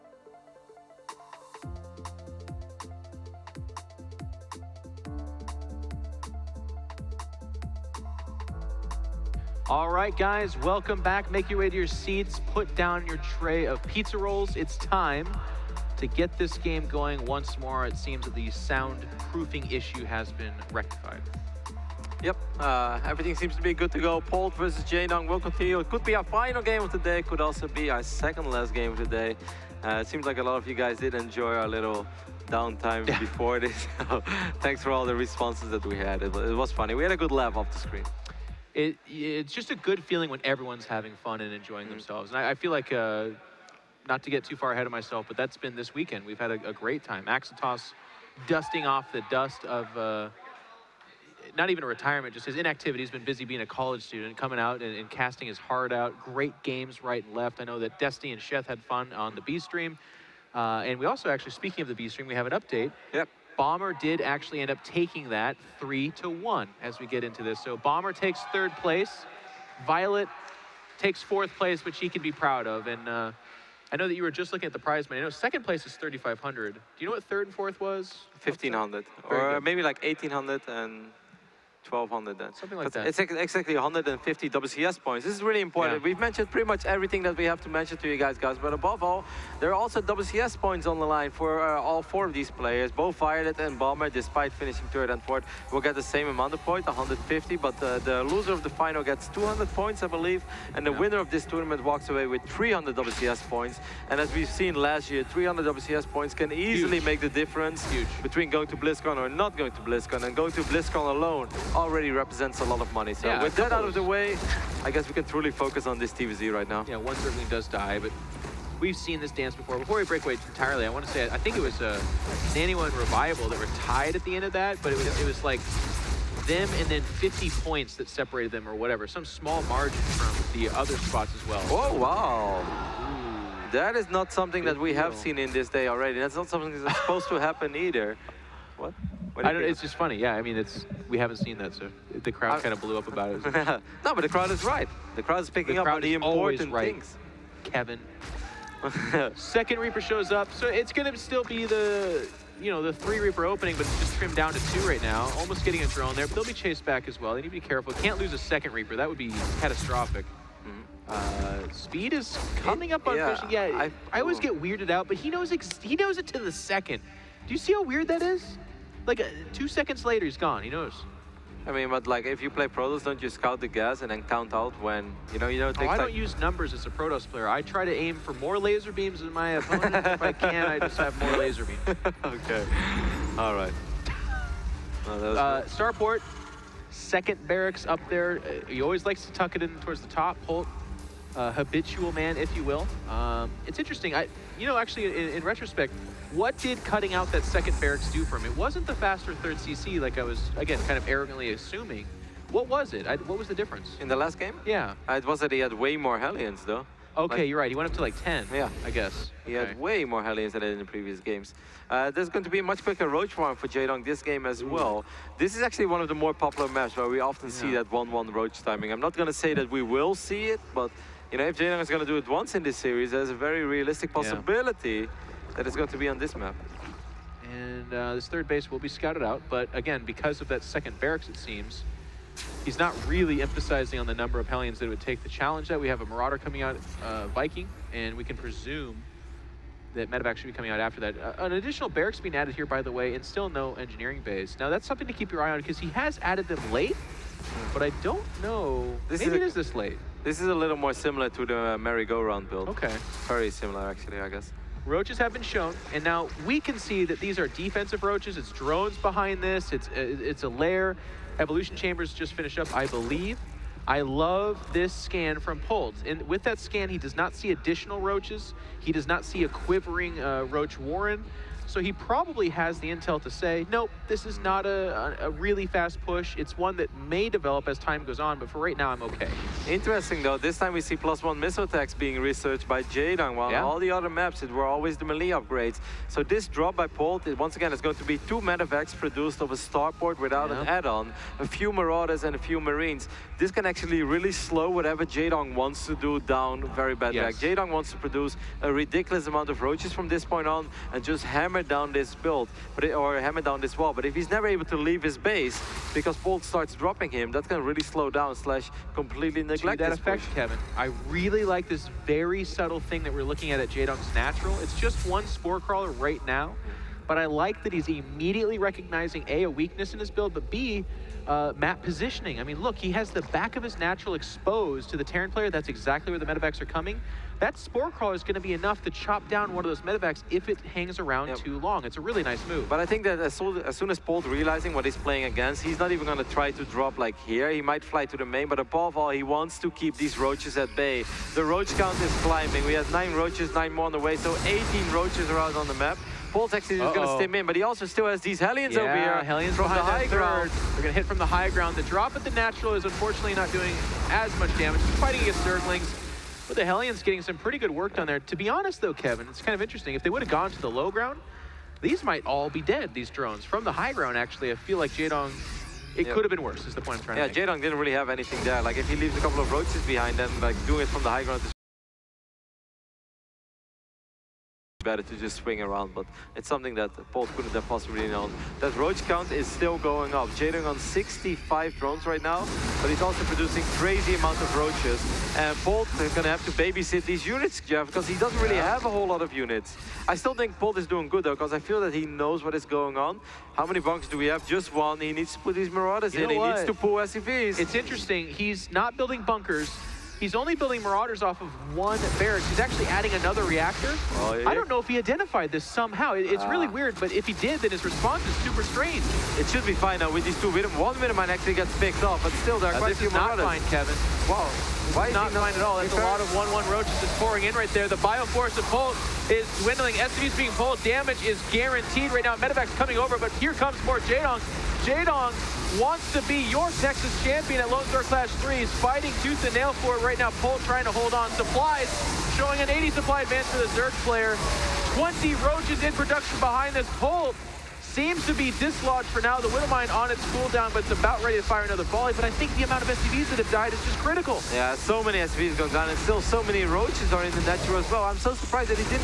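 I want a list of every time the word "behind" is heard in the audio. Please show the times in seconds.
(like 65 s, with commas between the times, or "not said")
258 s, 369 s, 436 s.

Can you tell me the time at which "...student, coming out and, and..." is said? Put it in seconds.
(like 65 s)
54 s.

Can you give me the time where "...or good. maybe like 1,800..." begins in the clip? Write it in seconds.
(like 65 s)
79 s.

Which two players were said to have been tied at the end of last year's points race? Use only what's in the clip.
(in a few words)
Nano and Revival.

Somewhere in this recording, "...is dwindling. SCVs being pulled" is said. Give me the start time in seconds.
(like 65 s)
419 s.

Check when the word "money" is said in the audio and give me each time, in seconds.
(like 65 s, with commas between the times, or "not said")
75 s, 112 s.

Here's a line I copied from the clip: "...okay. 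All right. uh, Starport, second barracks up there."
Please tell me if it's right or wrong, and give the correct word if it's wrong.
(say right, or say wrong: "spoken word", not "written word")
right.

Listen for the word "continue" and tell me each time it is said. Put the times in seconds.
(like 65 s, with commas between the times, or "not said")
25 s.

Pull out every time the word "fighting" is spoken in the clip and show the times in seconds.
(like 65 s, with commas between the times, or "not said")
355 s, 428 s.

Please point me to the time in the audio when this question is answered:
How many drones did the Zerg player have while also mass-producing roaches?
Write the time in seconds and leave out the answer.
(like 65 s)
380 s.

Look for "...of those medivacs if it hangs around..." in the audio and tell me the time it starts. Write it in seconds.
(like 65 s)
329 s.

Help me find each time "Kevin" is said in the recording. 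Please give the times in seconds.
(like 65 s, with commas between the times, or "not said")
147 s, 310 s, 358 s, 413 s.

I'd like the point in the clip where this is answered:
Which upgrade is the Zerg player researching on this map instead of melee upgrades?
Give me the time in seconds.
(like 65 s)
280 s.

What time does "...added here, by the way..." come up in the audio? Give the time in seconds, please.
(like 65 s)
242 s.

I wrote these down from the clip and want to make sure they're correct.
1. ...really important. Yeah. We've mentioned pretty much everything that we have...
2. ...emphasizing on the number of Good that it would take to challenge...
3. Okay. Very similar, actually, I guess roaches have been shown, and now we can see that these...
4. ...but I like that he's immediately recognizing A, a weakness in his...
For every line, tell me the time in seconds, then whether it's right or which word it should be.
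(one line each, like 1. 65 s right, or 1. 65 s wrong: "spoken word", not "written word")
1. 85 s right
2. 233 s wrong: "Hellions", not "Good"
3. 252 s right
4. 317 s right.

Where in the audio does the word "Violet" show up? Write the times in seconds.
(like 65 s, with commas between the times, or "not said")
69 s, 93 s.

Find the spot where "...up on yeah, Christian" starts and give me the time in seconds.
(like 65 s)
162 s.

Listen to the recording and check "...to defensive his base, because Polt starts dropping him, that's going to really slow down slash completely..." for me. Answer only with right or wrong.
wrong.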